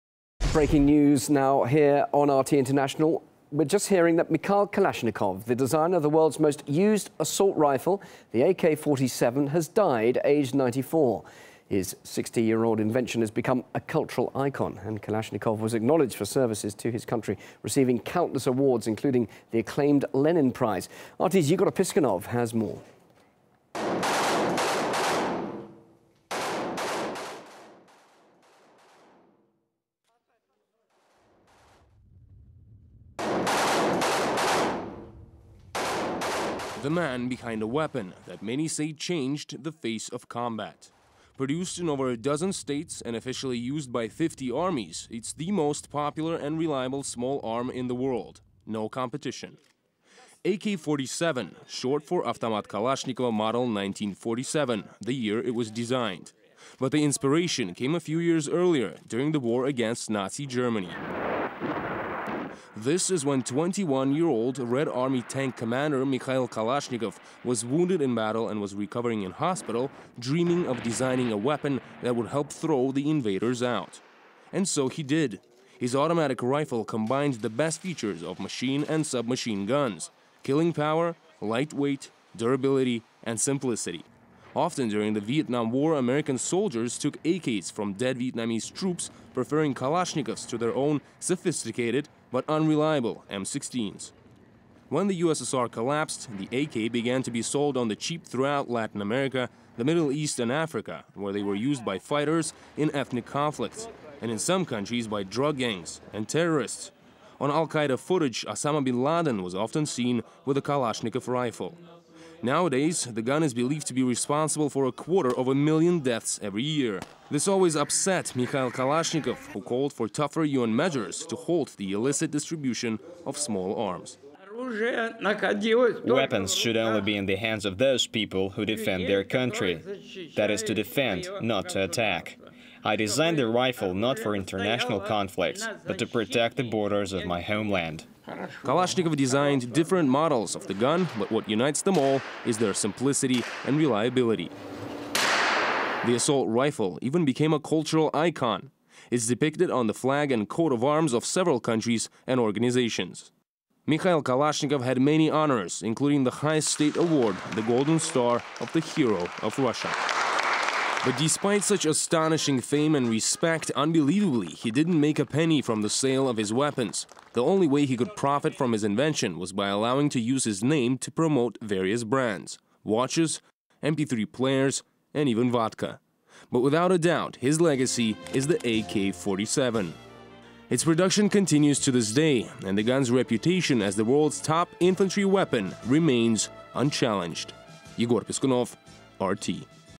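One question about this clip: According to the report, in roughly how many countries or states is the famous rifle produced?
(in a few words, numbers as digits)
over a dozen.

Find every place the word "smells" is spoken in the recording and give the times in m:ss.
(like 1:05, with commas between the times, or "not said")
not said.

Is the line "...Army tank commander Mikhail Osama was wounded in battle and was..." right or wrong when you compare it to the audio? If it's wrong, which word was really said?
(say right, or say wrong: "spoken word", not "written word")
wrong: "Kalashnikov", not "Osama".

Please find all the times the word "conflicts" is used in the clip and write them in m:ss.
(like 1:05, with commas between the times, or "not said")
1:43, 2:14.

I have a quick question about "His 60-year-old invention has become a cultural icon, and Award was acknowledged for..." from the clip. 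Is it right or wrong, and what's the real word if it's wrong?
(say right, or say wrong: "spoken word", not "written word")
wrong: "Kalashnikov", not "Award".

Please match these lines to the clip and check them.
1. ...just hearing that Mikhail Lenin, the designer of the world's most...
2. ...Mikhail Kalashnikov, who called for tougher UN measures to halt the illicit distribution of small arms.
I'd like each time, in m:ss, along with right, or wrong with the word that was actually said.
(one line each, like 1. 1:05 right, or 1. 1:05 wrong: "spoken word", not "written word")
1. 0:03 wrong: "Kalashnikov", not "Lenin"
2. 1:58 right.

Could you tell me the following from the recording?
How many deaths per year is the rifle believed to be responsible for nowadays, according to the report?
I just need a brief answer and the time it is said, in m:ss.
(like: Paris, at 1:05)
a quarter of a million, at 1:54.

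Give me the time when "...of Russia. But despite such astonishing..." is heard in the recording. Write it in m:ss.
2:39.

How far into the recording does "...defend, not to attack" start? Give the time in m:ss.
2:10.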